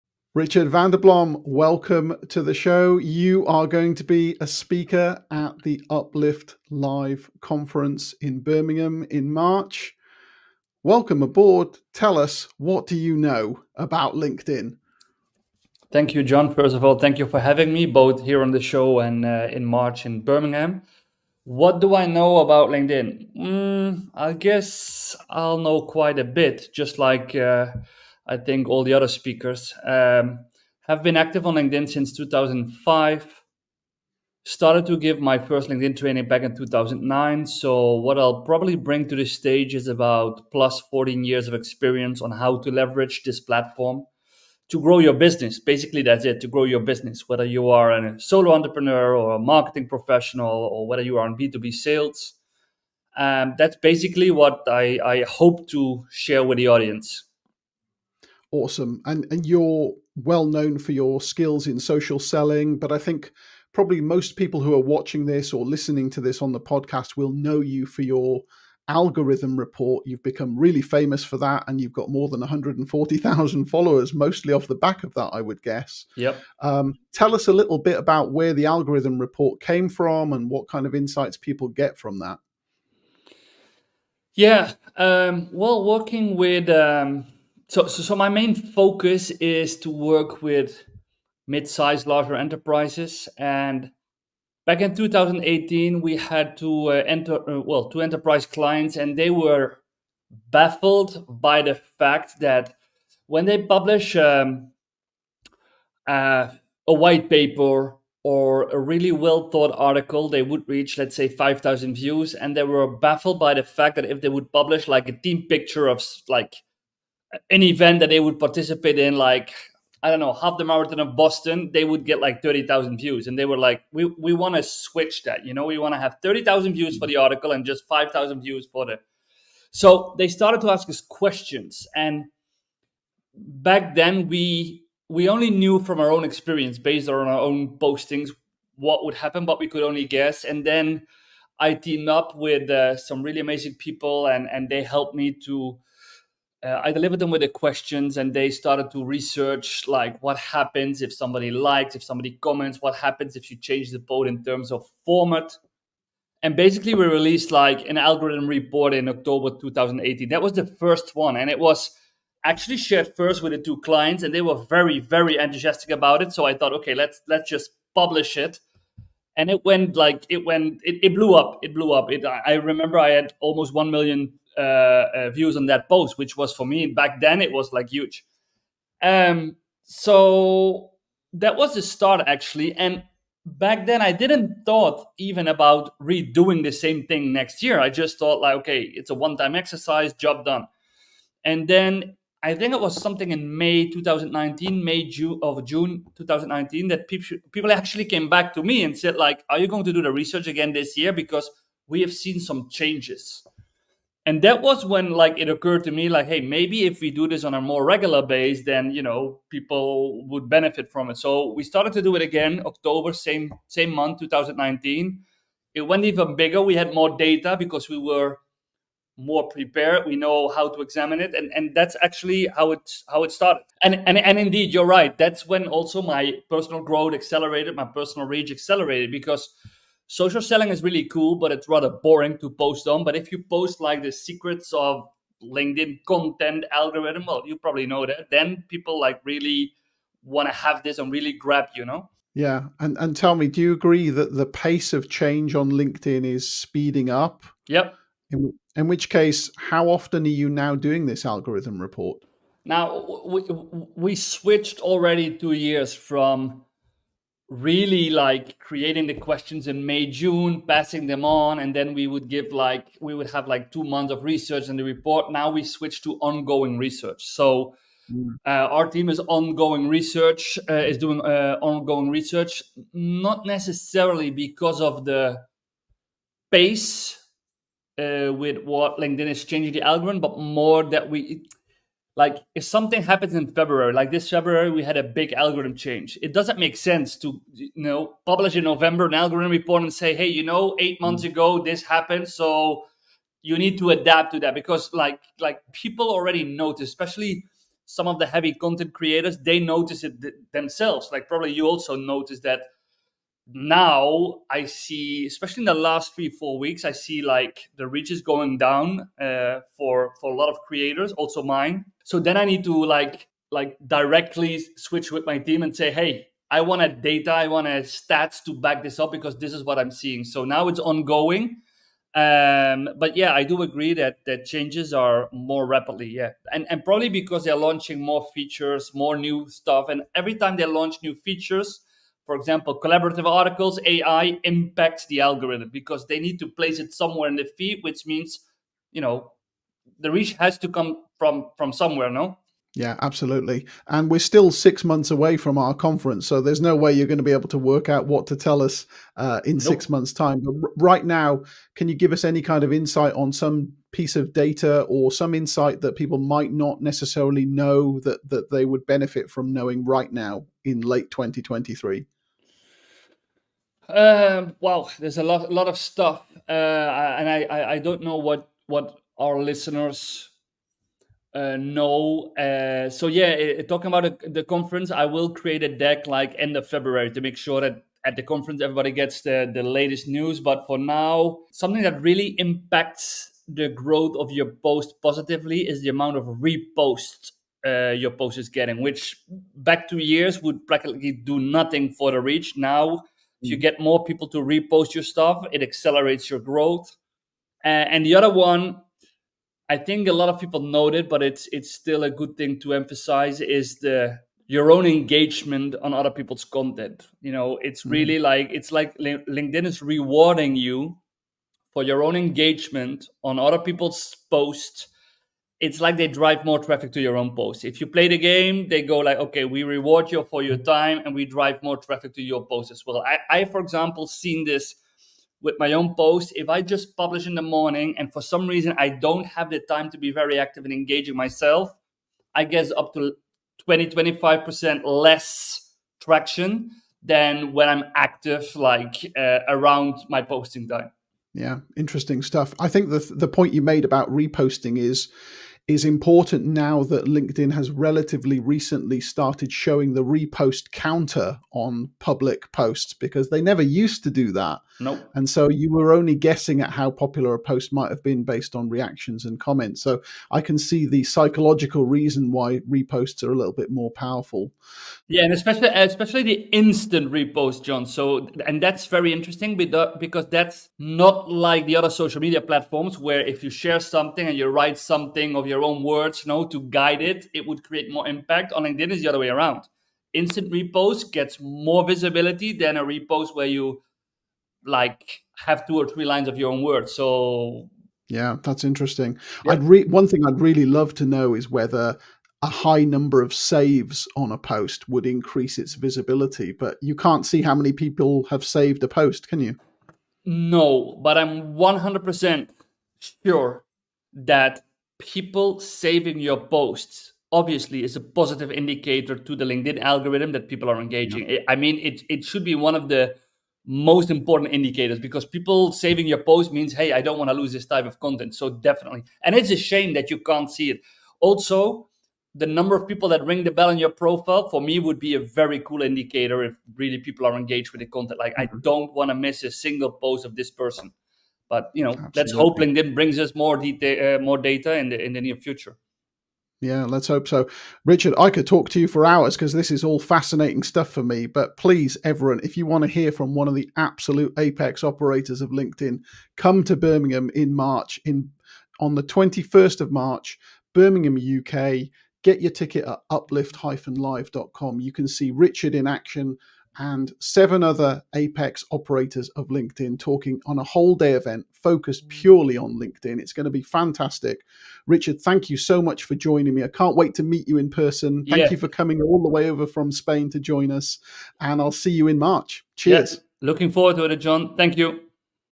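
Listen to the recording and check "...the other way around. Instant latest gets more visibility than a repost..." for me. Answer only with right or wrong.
wrong.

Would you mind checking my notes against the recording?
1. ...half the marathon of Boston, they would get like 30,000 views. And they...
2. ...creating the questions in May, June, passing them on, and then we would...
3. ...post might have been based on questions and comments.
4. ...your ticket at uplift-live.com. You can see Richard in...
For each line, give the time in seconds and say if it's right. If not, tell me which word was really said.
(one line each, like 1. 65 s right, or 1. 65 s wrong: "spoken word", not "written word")
1. 120 s right
2. 258 s right
3. 457 s wrong: "reactions", not "questions"
4. 552 s right.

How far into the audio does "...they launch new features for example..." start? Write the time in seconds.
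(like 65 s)
330 s.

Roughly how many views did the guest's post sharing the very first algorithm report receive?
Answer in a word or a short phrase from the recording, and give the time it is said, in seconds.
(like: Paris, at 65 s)
Almost one million, at 173 s.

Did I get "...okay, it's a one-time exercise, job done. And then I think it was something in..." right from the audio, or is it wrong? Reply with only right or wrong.
right.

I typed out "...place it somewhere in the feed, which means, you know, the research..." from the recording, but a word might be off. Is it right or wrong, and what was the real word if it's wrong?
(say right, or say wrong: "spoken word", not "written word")
wrong: "reach", not "research".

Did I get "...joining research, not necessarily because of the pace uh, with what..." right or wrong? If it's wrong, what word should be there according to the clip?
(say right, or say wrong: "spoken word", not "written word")
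wrong: "ongoing", not "joining".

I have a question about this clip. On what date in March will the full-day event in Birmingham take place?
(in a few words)
21st of March.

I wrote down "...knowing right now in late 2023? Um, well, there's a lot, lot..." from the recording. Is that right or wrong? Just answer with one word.
right.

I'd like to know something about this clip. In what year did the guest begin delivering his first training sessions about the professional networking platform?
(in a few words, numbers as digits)
2009.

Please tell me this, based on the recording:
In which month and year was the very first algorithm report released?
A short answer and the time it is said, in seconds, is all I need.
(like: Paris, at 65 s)
October 2018, at 159 s.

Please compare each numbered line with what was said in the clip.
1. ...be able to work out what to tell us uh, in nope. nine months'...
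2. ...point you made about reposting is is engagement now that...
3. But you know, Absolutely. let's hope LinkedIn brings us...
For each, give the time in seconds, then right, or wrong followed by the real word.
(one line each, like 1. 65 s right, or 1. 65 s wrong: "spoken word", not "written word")
1. 347 s wrong: "six", not "nine"
2. 443 s wrong: "important", not "engagement"
3. 531 s right.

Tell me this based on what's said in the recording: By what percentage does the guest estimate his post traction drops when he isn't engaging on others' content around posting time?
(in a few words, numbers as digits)
20 to 25%.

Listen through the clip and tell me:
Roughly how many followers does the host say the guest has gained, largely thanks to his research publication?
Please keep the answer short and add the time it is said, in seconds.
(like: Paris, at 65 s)
140,000, at 72 s.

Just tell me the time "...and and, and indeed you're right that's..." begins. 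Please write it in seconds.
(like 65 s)
223 s.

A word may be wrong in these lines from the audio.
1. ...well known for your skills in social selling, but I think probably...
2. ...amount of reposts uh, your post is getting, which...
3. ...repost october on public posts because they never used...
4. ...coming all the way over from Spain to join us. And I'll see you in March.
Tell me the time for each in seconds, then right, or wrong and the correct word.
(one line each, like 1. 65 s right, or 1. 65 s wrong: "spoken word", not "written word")
1. 60 s right
2. 385 s right
3. 450 s wrong: "counter", not "october"
4. 568 s right.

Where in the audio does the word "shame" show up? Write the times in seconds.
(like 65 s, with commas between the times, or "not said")
519 s.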